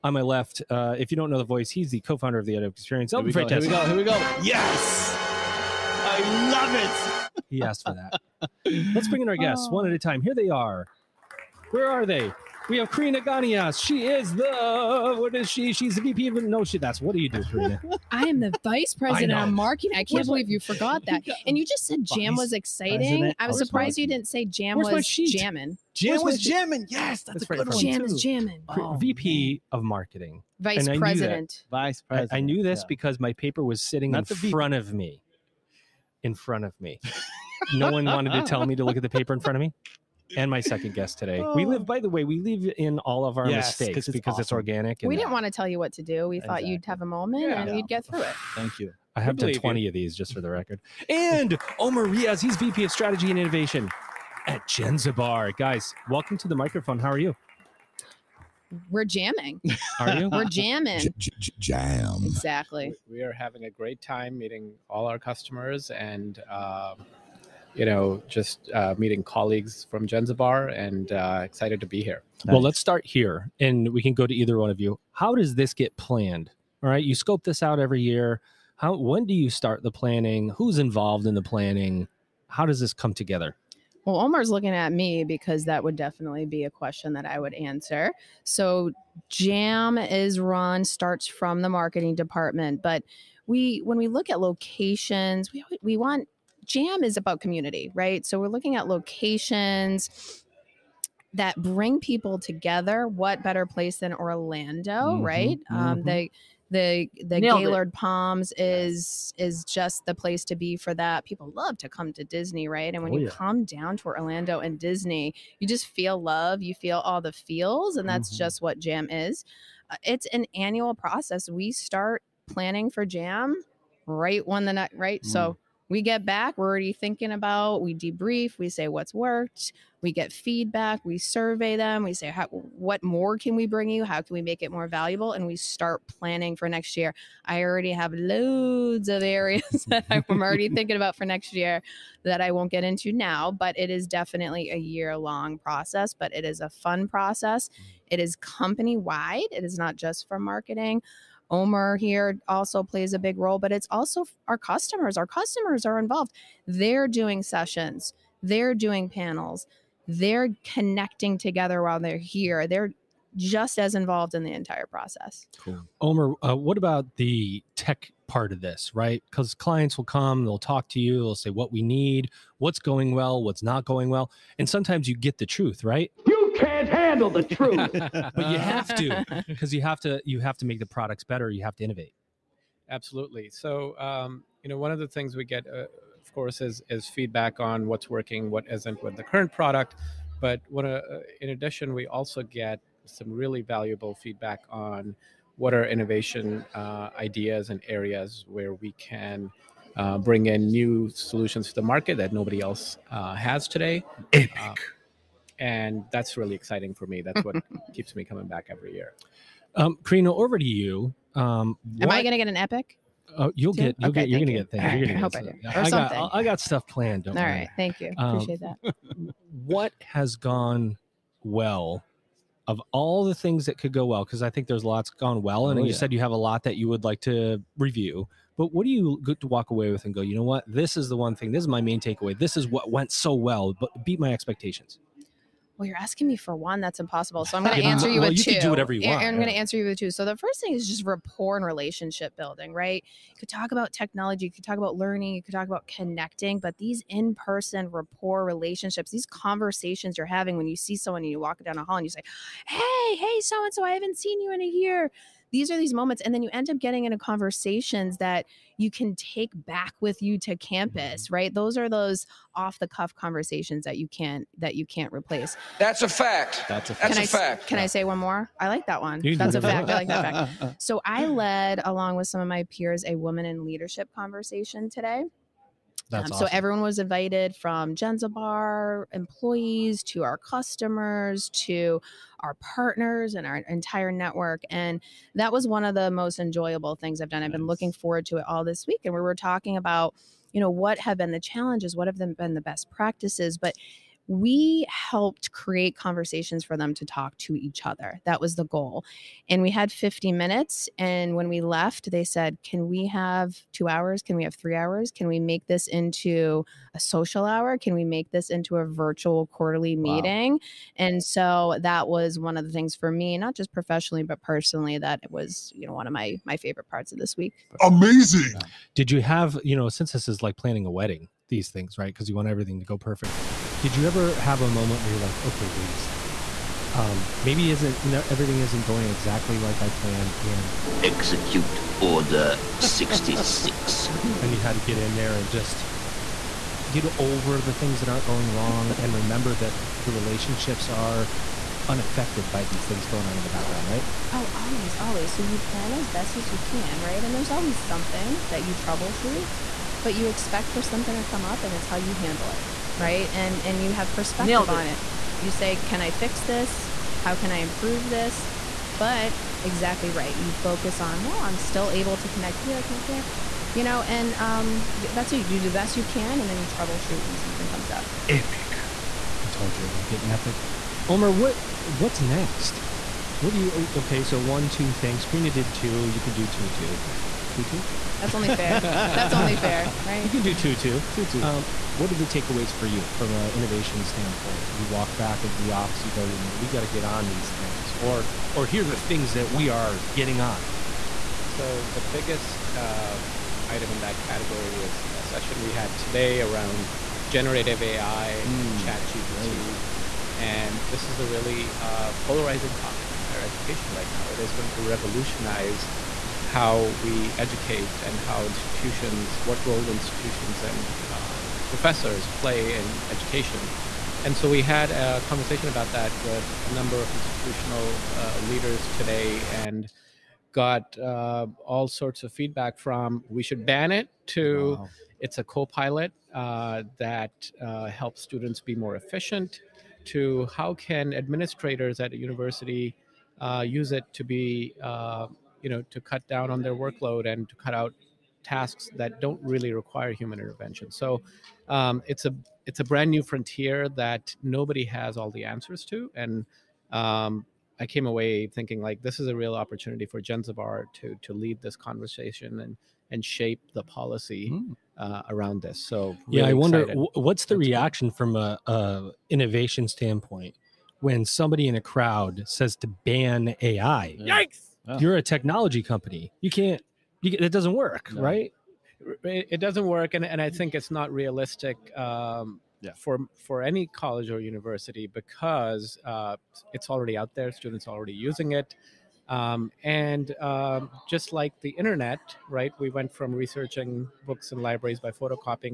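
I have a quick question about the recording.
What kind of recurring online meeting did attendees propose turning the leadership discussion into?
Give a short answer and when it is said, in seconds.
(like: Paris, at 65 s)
Virtual quarterly meeting, at 308 s.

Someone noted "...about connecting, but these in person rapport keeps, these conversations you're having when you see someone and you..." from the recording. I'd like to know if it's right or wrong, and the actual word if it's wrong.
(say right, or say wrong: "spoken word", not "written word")
wrong: "relationships", not "keeps".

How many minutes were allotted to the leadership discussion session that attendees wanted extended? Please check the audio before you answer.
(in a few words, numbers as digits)
50.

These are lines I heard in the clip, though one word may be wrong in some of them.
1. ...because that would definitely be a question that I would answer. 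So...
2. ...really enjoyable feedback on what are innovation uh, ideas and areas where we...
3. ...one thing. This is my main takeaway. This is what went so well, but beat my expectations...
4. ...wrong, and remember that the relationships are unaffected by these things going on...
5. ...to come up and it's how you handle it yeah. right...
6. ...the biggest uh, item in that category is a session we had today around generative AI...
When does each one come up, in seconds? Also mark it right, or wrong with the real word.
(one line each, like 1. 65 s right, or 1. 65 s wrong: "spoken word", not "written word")
1. 85 s right
2. 193 s wrong: "valuable", not "enjoyable"
3. 231 s right
4. 338 s right
5. 351 s right
6. 391 s right.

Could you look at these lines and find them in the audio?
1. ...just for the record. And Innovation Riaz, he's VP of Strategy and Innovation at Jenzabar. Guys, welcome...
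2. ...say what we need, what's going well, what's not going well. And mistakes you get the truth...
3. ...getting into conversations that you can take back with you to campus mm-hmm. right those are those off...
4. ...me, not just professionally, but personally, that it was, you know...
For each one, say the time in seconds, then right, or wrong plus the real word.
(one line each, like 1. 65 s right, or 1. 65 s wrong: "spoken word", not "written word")
1. 50 s wrong: "Omer", not "Innovation"
2. 171 s wrong: "sometimes", not "mistakes"
3. 256 s right
4. 313 s right.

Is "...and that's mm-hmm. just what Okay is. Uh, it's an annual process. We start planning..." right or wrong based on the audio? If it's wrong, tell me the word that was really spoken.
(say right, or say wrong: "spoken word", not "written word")
wrong: "Jam", not "Okay".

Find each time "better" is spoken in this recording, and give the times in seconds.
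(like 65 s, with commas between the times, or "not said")
103 s, 181 s.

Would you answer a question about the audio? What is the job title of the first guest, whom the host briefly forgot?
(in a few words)
Vice president of marketing.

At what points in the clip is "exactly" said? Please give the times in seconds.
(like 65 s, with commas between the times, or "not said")
46 s, 62 s, 329 s, 359 s.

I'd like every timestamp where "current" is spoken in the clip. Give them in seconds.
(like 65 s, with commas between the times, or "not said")
189 s.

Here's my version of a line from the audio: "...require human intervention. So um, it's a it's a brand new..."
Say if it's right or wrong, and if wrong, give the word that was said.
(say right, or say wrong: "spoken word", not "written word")
right.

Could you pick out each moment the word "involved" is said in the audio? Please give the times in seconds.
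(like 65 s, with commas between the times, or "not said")
80 s, 155 s, 163 s.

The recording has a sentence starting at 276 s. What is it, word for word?
So everyone was invited from Jenzabar employees to our customers to our partners and our entire network.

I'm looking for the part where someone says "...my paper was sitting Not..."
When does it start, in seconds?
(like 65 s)
33 s.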